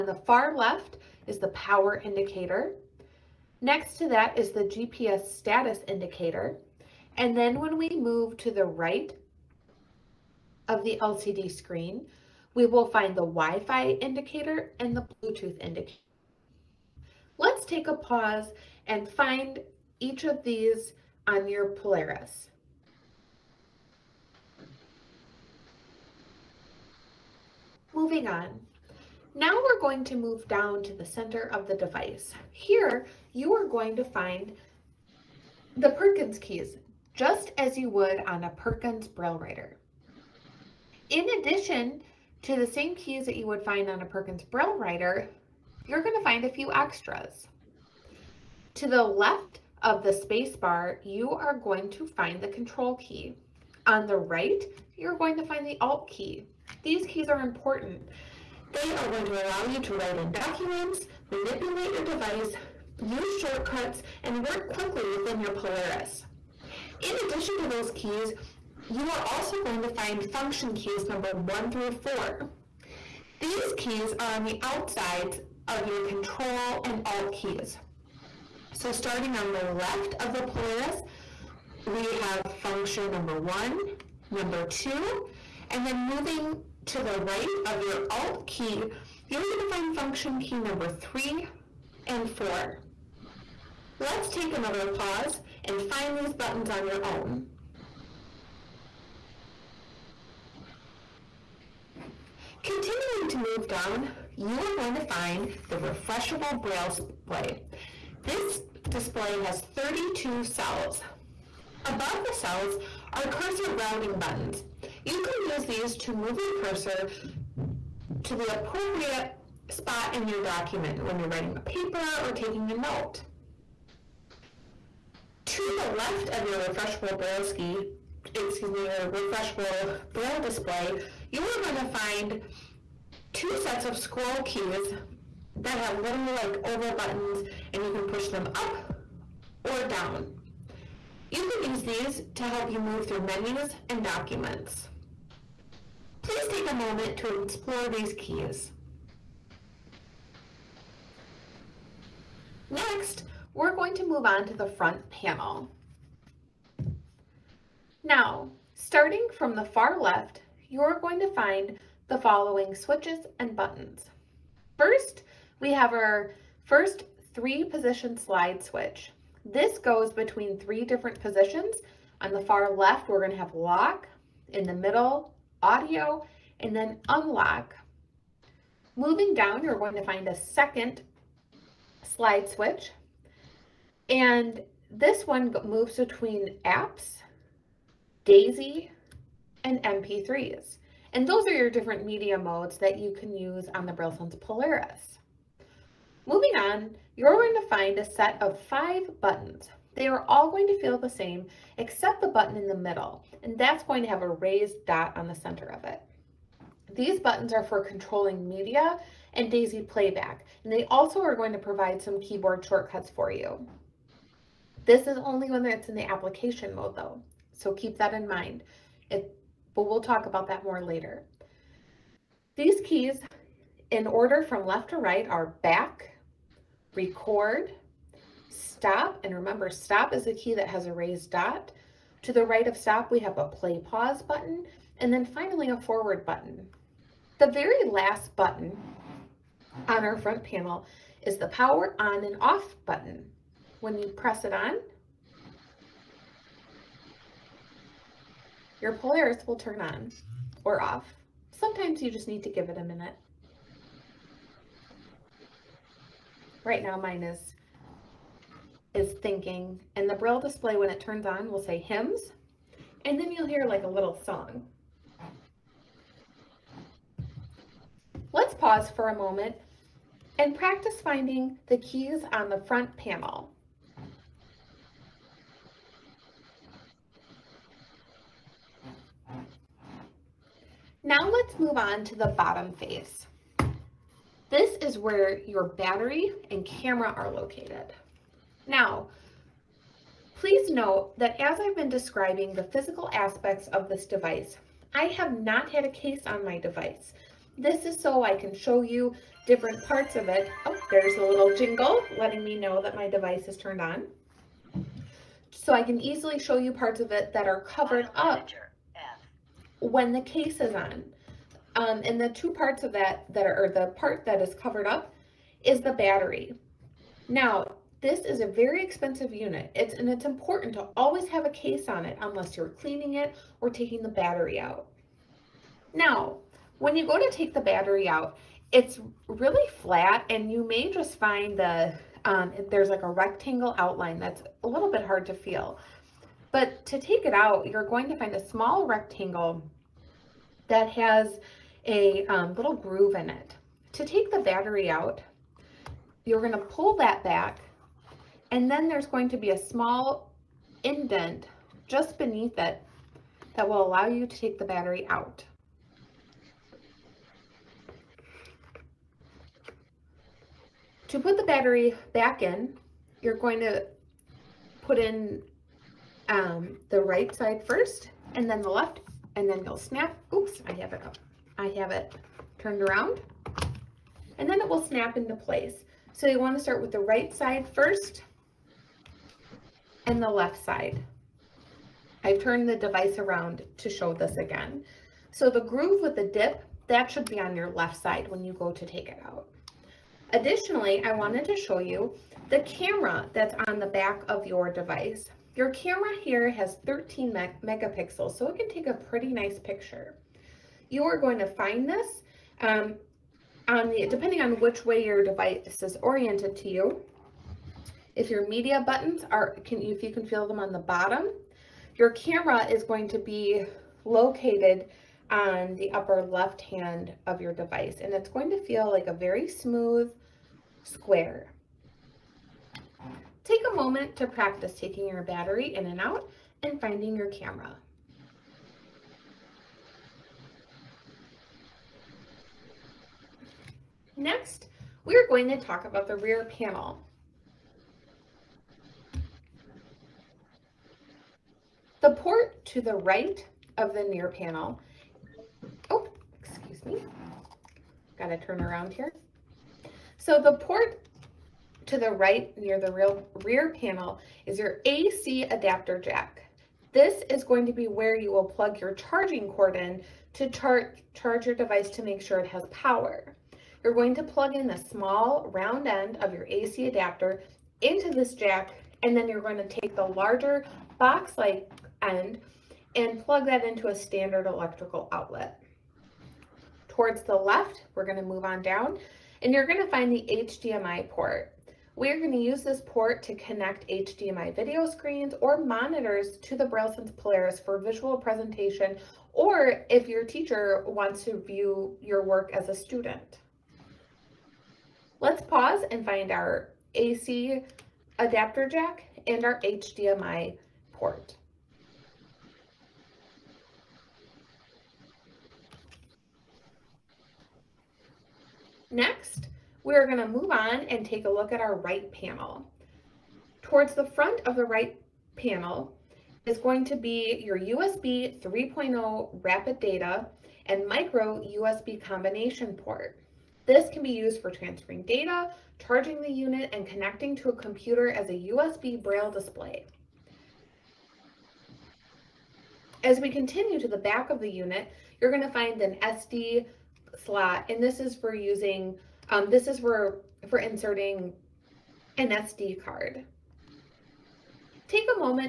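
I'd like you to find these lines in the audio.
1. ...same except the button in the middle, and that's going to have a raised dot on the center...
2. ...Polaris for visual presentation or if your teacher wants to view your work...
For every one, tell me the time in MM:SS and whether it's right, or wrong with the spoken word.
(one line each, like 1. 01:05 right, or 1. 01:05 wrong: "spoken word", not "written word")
1. 03:21 right
2. 08:07 right.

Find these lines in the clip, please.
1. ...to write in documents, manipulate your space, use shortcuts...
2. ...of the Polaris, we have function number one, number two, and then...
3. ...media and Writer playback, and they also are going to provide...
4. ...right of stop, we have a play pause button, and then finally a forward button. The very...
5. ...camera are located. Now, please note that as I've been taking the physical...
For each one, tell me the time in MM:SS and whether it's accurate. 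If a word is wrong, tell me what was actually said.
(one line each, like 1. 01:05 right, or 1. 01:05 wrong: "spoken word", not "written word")
1. 00:59 wrong: "device", not "space"
2. 01:20 right
3. 03:28 wrong: "DAISY", not "Writer"
4. 03:52 right
5. 04:46 wrong: "describing", not "taking".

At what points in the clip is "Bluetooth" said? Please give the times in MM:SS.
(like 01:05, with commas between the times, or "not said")
00:15.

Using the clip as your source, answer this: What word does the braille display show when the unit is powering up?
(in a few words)
HIMS.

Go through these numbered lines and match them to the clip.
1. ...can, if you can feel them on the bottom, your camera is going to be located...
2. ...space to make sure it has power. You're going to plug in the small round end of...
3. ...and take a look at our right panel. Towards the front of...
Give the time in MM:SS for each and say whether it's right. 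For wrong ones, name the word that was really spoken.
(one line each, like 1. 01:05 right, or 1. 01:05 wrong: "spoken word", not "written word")
1. 06:49 right
2. 07:41 wrong: "device", not "space"
3. 08:30 right.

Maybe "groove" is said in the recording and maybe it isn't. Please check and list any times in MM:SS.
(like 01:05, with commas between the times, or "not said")
05:42, 06:25.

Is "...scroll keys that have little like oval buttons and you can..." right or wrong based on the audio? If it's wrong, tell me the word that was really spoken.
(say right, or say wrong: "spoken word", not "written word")
right.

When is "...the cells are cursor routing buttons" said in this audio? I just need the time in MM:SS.
01:52.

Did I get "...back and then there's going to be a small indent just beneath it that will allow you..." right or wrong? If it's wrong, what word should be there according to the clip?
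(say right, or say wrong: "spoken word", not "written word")
right.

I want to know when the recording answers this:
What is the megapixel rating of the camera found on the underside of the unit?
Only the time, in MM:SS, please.
06:36.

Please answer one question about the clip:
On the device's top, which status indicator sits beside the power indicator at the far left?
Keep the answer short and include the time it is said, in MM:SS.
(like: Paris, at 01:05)
GPS status indicator, at 00:04.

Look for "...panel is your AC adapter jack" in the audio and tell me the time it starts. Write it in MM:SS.
07:33.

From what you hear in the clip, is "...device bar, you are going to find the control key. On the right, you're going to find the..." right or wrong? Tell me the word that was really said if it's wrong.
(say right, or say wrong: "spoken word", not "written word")
wrong: "space", not "device".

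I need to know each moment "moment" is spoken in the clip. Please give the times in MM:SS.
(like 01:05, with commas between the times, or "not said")
02:26, 04:29, 07:03.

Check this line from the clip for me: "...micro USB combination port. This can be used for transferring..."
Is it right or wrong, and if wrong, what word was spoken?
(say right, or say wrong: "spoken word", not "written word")
right.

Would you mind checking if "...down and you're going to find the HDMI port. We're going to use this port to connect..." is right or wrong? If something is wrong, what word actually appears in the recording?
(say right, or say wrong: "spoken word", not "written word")
right.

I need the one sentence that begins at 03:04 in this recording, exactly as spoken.
And this one moves between apps, DAISY, and MP3s.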